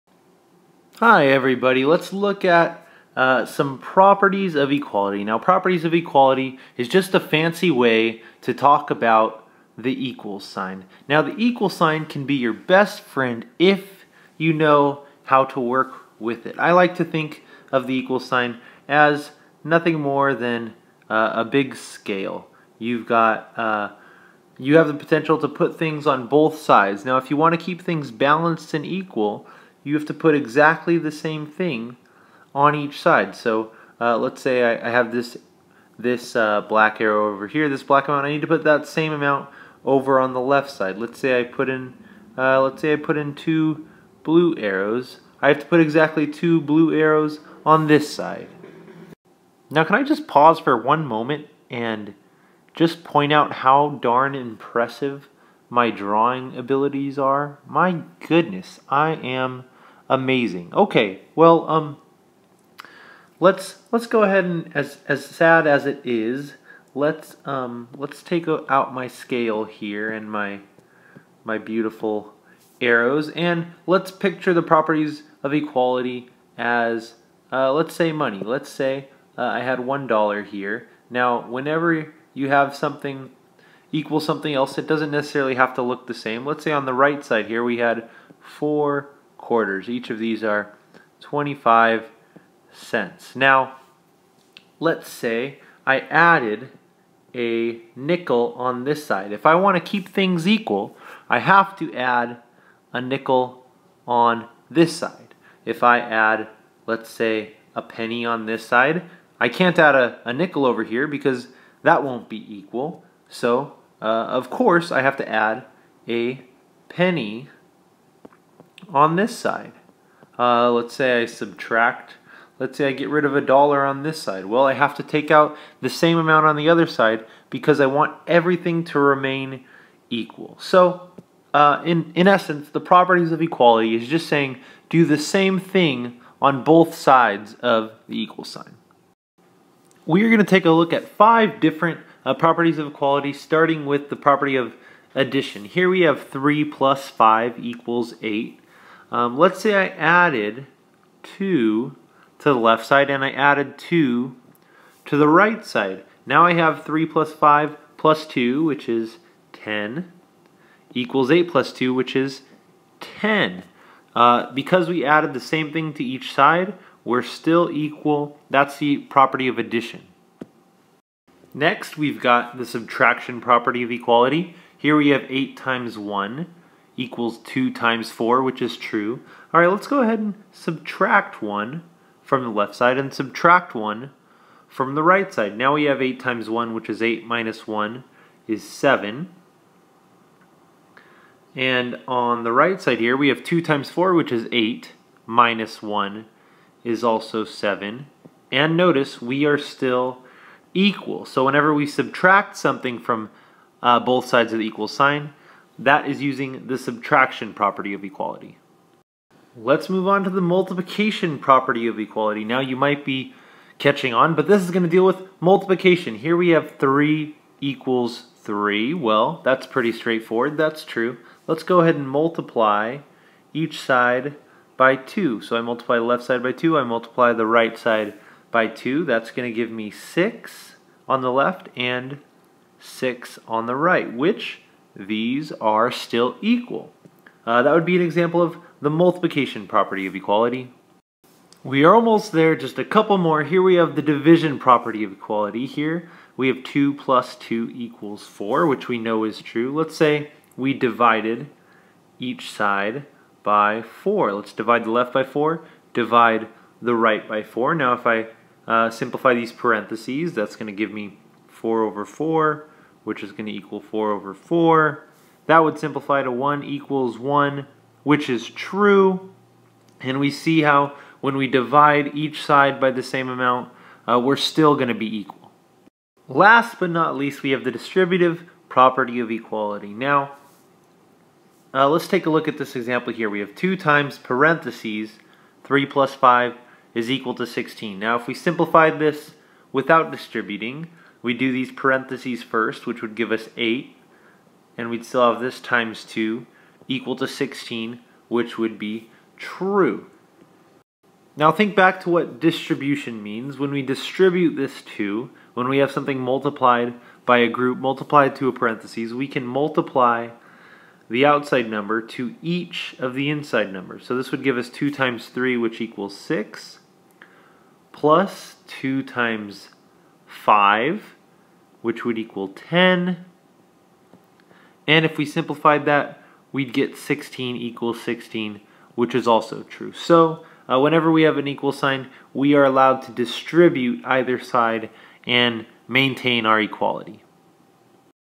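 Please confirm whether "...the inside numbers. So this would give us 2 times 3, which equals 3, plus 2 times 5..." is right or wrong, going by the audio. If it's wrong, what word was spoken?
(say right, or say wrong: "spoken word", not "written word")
wrong: "6", not "3".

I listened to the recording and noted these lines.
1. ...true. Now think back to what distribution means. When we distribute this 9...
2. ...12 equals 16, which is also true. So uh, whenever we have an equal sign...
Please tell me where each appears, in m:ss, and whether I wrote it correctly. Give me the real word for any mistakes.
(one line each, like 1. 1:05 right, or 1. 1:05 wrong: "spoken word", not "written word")
1. 4:59 wrong: "2", not "9"
2. 5:26 wrong: "16", not "12".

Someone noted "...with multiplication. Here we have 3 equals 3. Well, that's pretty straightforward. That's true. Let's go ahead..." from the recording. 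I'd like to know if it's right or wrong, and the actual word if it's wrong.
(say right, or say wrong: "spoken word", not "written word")
right.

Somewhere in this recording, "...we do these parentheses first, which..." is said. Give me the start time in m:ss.
4:51.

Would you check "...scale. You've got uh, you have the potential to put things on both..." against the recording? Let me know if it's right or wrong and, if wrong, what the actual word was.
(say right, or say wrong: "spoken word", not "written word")
right.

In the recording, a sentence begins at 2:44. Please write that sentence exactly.
Uh, because we added the same thing to each side, we're still equal.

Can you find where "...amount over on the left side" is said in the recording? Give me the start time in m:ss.
0:39.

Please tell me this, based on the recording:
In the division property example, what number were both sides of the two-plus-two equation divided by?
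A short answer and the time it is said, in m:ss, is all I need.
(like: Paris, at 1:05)
4, at 4:10.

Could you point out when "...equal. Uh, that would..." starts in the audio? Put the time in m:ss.
3:56.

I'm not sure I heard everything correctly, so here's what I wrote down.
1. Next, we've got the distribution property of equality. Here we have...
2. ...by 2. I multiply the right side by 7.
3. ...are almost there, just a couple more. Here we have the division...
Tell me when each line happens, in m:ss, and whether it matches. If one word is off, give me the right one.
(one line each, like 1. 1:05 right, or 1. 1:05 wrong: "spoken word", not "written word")
1. 2:51 wrong: "subtraction", not "distribution"
2. 3:46 wrong: "2", not "7"
3. 4:01 right.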